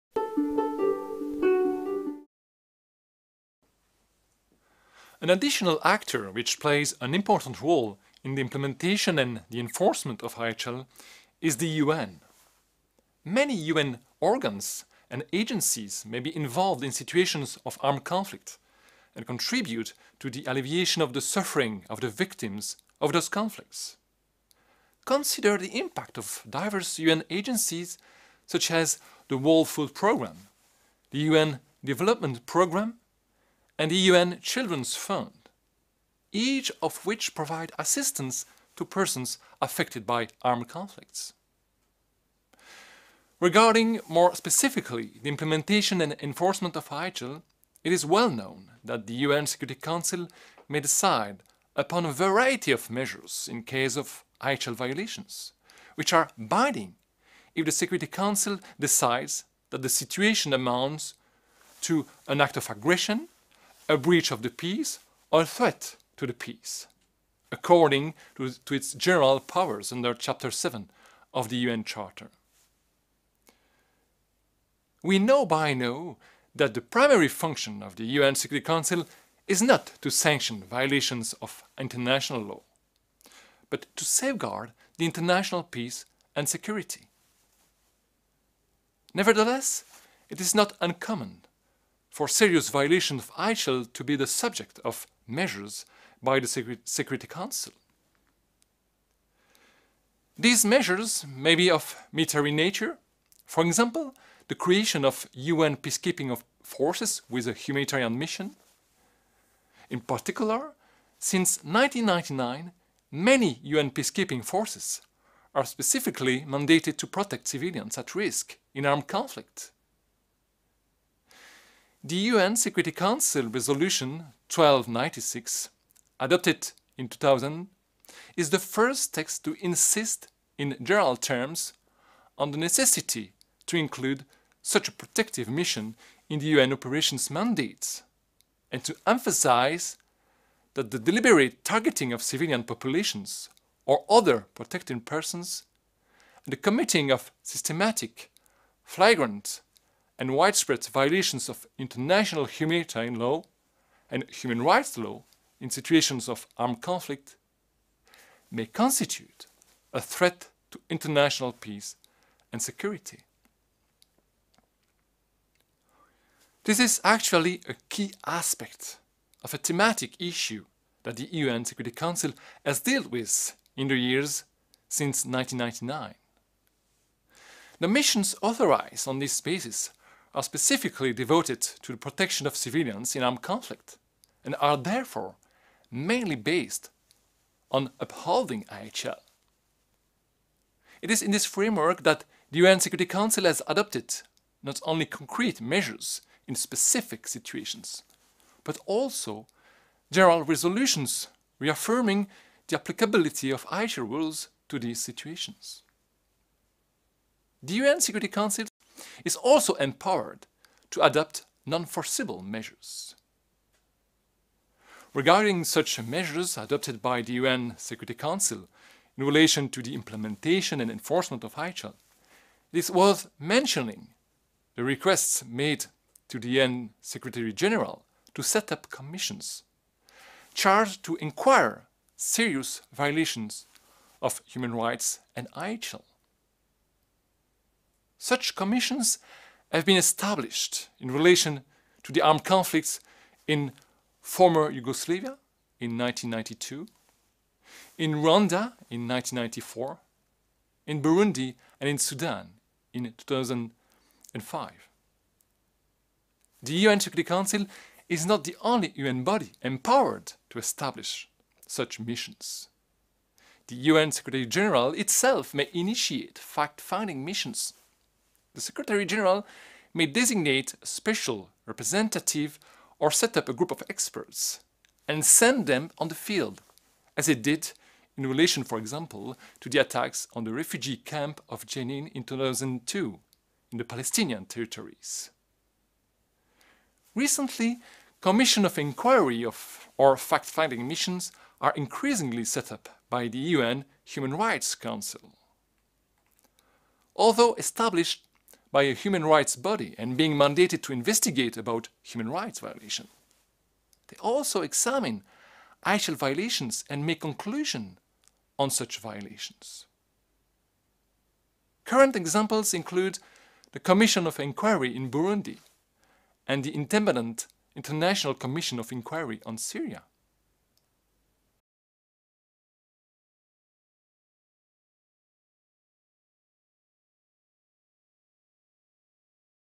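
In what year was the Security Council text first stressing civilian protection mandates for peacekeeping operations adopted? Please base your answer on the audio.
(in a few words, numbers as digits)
2000.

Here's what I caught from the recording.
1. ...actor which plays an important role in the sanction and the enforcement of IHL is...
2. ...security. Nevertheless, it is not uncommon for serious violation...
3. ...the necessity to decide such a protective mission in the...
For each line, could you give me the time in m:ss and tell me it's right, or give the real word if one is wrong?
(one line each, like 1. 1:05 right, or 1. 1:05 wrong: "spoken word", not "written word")
1. 0:05 wrong: "implementation", not "sanction"
2. 1:26 right
3. 2:12 wrong: "include", not "decide".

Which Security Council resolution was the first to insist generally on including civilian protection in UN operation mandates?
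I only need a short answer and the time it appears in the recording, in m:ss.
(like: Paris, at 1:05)
Resolution 1296, at 2:03.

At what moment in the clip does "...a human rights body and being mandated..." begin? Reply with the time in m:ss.
4:58.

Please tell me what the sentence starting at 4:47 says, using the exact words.
Recently, commission of inquiry of, or fact-finding missions are increasingly set up by the UN Human Rights Council.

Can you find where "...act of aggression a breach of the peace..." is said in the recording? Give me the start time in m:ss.
1:02.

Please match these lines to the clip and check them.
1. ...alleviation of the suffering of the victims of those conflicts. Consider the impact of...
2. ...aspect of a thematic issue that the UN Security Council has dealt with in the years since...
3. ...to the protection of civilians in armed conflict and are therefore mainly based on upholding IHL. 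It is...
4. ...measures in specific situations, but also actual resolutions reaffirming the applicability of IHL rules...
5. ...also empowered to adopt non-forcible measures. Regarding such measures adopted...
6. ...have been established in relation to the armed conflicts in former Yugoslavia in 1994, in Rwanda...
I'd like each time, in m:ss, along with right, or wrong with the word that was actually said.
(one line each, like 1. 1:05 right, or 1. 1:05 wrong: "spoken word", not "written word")
1. 0:20 right
2. 2:48 right
3. 3:01 right
4. 3:15 wrong: "general", not "actual"
5. 3:29 right
6. 3:59 wrong: "1992", not "1994".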